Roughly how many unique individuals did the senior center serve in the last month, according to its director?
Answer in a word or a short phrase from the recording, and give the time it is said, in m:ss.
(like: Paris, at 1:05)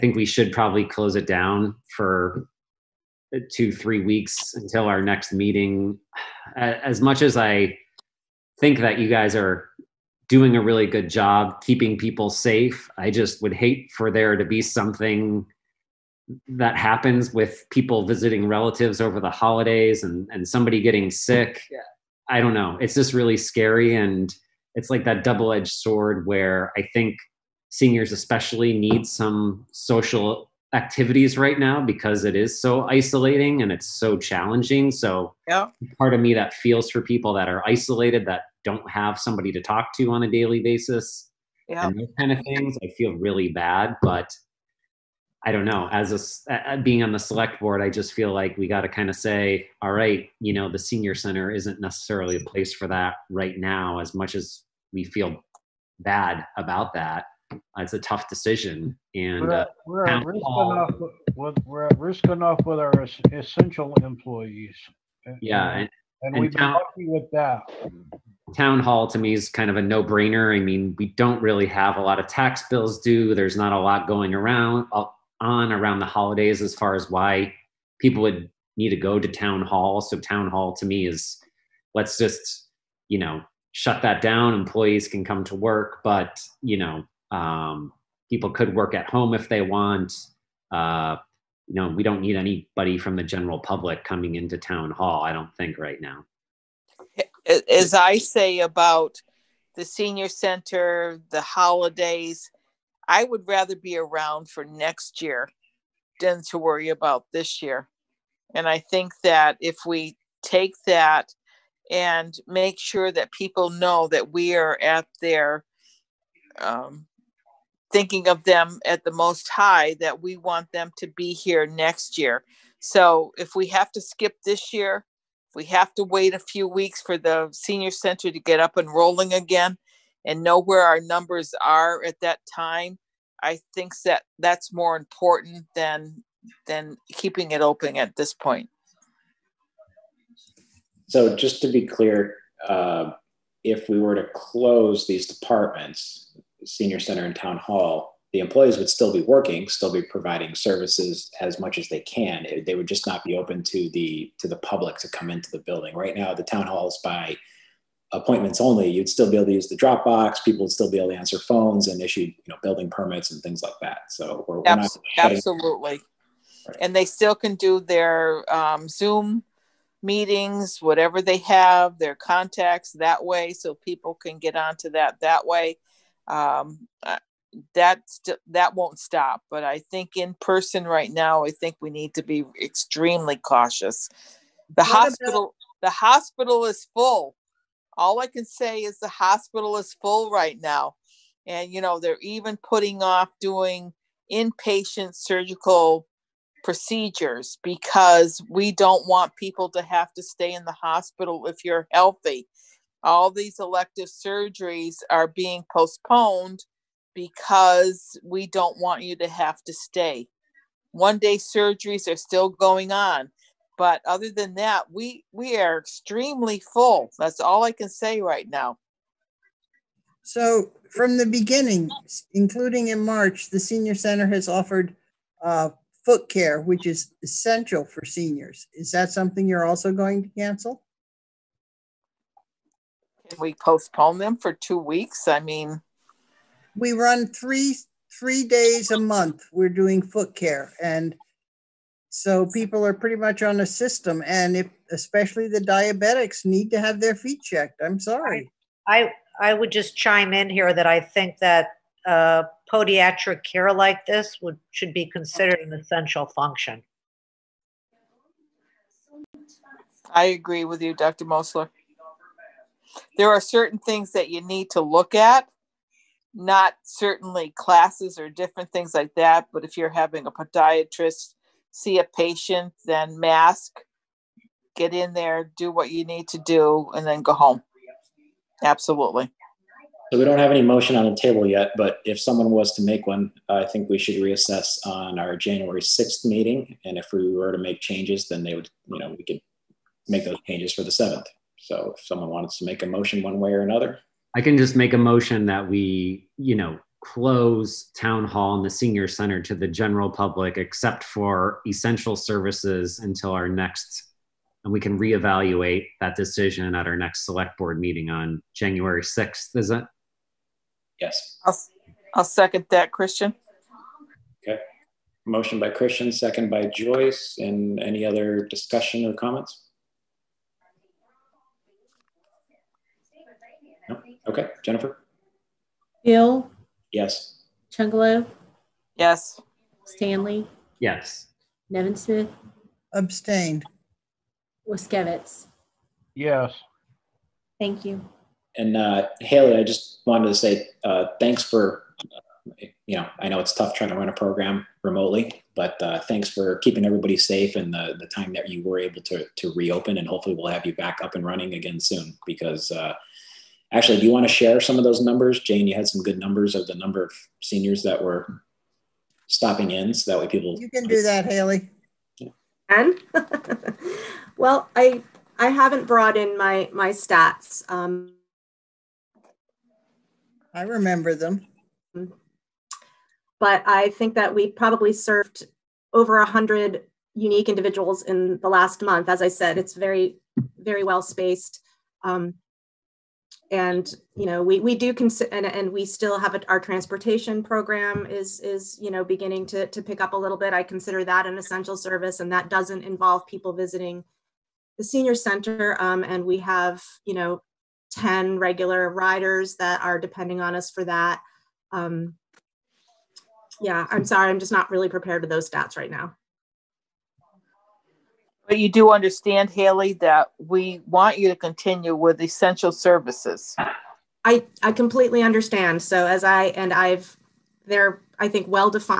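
over 100, at 6:15.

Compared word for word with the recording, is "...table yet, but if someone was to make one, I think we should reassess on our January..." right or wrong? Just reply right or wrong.
right.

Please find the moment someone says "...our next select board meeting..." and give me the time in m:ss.
5:06.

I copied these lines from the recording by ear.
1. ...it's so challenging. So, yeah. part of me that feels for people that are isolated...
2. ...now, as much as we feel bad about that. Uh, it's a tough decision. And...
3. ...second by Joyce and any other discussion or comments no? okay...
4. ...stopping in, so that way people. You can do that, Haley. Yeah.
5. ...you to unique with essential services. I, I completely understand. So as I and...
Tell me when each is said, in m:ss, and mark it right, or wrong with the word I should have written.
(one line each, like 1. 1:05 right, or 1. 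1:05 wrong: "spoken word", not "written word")
1. 0:33 right
2. 0:53 right
3. 5:16 right
4. 5:59 right
5. 6:51 wrong: "continue", not "unique".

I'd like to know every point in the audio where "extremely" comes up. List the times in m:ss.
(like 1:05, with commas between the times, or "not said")
3:02, 3:35.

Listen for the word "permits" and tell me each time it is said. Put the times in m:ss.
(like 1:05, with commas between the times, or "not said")
2:42.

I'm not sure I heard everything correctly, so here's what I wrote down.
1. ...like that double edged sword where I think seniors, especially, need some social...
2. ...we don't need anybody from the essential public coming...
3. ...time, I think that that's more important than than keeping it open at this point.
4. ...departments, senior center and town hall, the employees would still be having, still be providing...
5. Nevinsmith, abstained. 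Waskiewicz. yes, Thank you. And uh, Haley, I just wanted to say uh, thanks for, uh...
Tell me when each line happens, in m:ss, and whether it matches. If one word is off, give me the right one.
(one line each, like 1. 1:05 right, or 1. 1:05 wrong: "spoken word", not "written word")
1. 0:24 right
2. 1:31 wrong: "general", not "essential"
3. 2:12 right
4. 2:25 wrong: "working", not "having"
5. 5:31 right.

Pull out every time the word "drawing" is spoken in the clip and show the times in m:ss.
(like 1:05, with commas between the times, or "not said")
not said.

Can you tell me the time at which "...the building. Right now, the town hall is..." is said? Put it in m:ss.
2:35.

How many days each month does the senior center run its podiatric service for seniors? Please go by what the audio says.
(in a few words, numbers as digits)
3.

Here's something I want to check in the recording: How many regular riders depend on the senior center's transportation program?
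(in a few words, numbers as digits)
10.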